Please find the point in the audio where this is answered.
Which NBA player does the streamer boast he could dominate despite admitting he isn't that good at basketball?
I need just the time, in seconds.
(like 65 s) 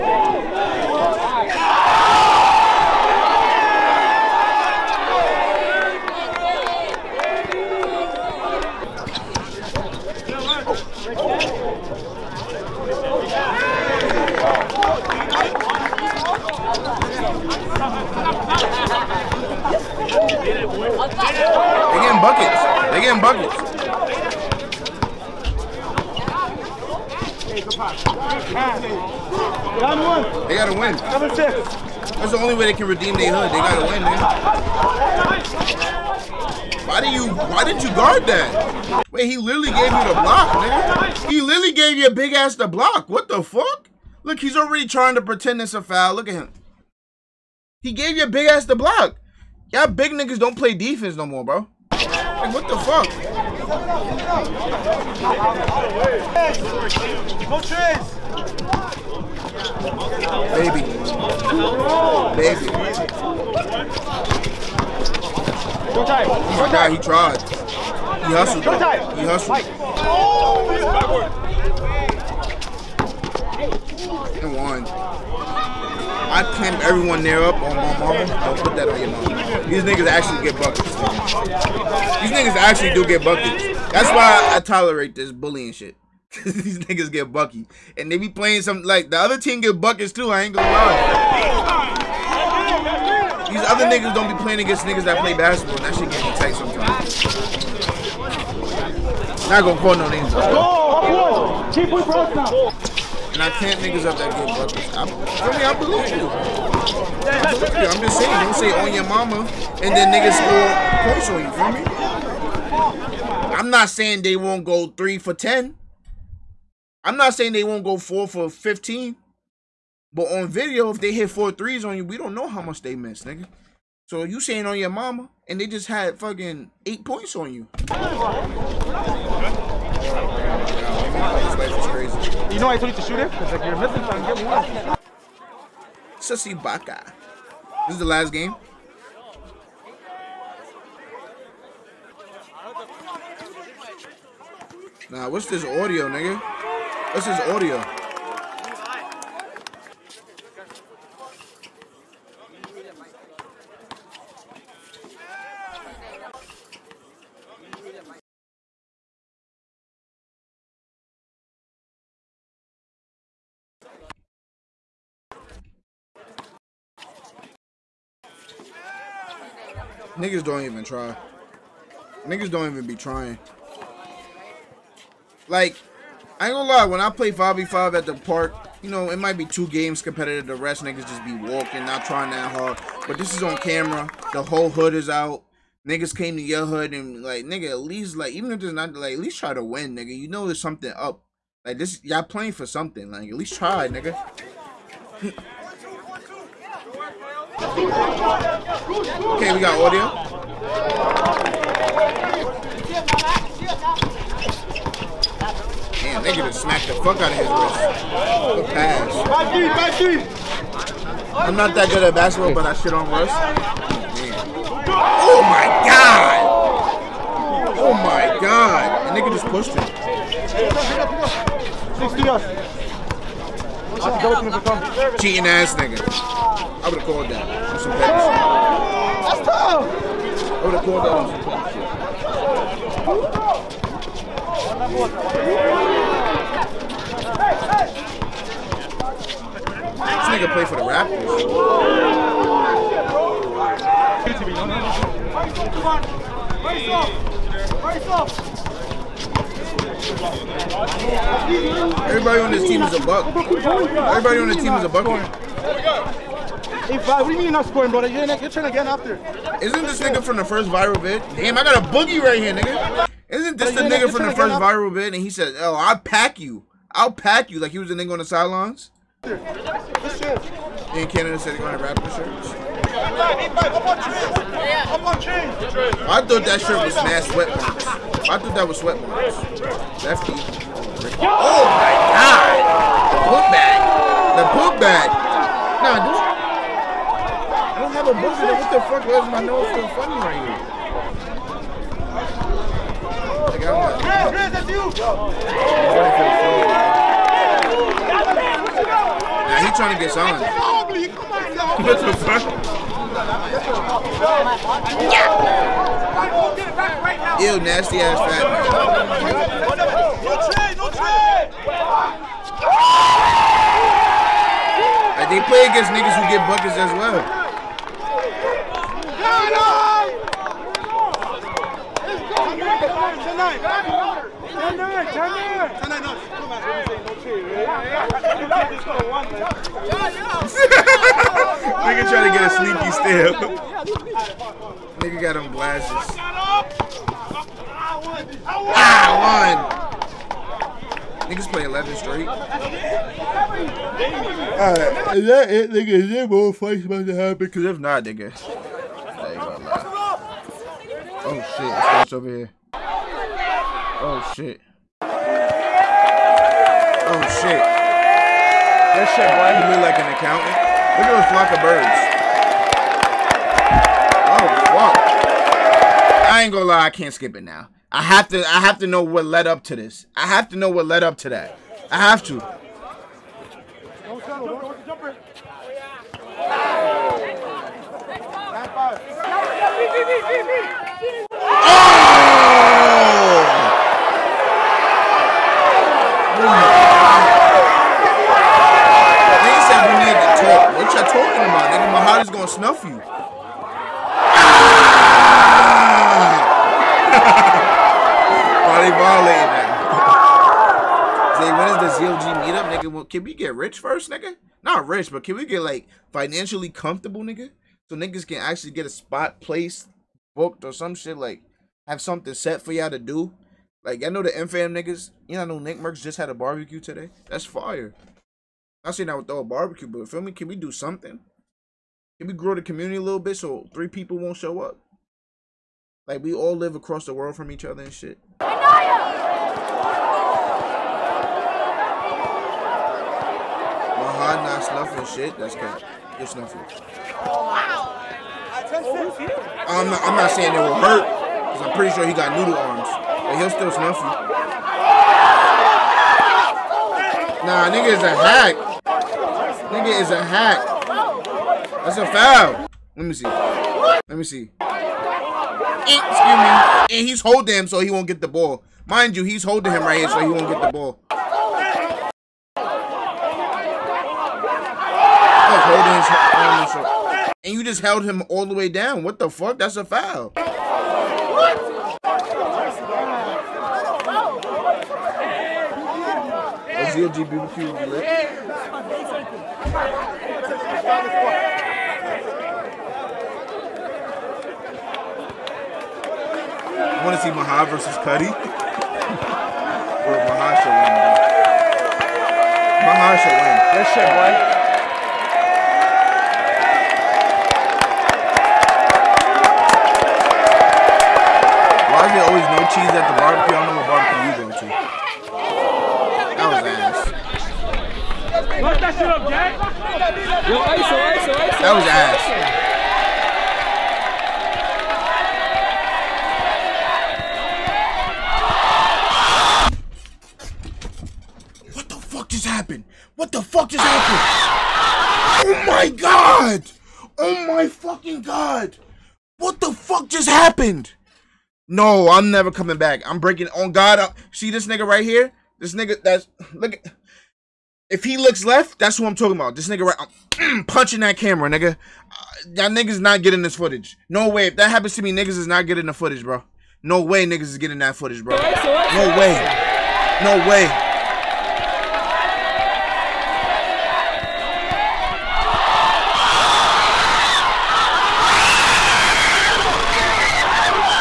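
213 s.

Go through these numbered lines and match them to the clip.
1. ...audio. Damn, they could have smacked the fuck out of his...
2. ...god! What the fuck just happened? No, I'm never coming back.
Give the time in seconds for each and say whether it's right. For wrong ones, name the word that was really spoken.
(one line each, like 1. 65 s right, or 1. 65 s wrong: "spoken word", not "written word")
1. 199 s right
2. 528 s right.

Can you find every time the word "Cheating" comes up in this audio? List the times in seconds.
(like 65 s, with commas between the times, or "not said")
223 s.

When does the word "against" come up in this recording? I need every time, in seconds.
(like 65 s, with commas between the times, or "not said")
94 s, 315 s.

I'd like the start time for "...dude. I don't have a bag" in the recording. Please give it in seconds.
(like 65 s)
286 s.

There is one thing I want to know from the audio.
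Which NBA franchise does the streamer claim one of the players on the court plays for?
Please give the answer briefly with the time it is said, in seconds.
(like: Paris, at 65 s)
Raptors, at 240 s.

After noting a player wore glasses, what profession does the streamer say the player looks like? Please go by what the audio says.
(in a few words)
accountant.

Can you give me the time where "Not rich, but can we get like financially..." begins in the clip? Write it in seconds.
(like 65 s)
404 s.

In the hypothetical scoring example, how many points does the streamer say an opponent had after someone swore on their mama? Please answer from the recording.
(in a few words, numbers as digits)
8.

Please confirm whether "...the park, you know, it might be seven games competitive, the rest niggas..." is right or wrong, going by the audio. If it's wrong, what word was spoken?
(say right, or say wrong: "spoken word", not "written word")
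wrong: "two", not "seven".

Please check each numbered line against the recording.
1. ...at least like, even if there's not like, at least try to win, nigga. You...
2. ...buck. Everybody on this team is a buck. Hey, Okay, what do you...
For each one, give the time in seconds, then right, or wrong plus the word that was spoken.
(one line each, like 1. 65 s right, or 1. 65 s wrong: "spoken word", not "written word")
1. 187 s right
2. 253 s wrong: "Vlad", not "Okay".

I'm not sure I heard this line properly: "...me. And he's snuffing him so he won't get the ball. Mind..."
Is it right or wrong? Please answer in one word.
wrong.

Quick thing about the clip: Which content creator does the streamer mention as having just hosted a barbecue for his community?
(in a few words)
Nick Mercs.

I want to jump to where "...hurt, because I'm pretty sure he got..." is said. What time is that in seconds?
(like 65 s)
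440 s.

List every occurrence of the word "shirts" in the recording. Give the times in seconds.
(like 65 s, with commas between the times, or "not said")
272 s, 276 s.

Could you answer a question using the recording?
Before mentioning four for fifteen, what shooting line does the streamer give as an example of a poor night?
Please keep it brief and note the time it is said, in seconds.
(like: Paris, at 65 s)
3 for 10, at 114 s.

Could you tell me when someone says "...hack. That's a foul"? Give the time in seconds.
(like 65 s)
450 s.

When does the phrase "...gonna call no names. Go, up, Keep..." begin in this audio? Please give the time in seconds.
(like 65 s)
99 s.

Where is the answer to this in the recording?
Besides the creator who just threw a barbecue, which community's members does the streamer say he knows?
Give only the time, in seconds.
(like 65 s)
414 s.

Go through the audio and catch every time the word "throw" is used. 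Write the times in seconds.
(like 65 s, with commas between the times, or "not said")
419 s.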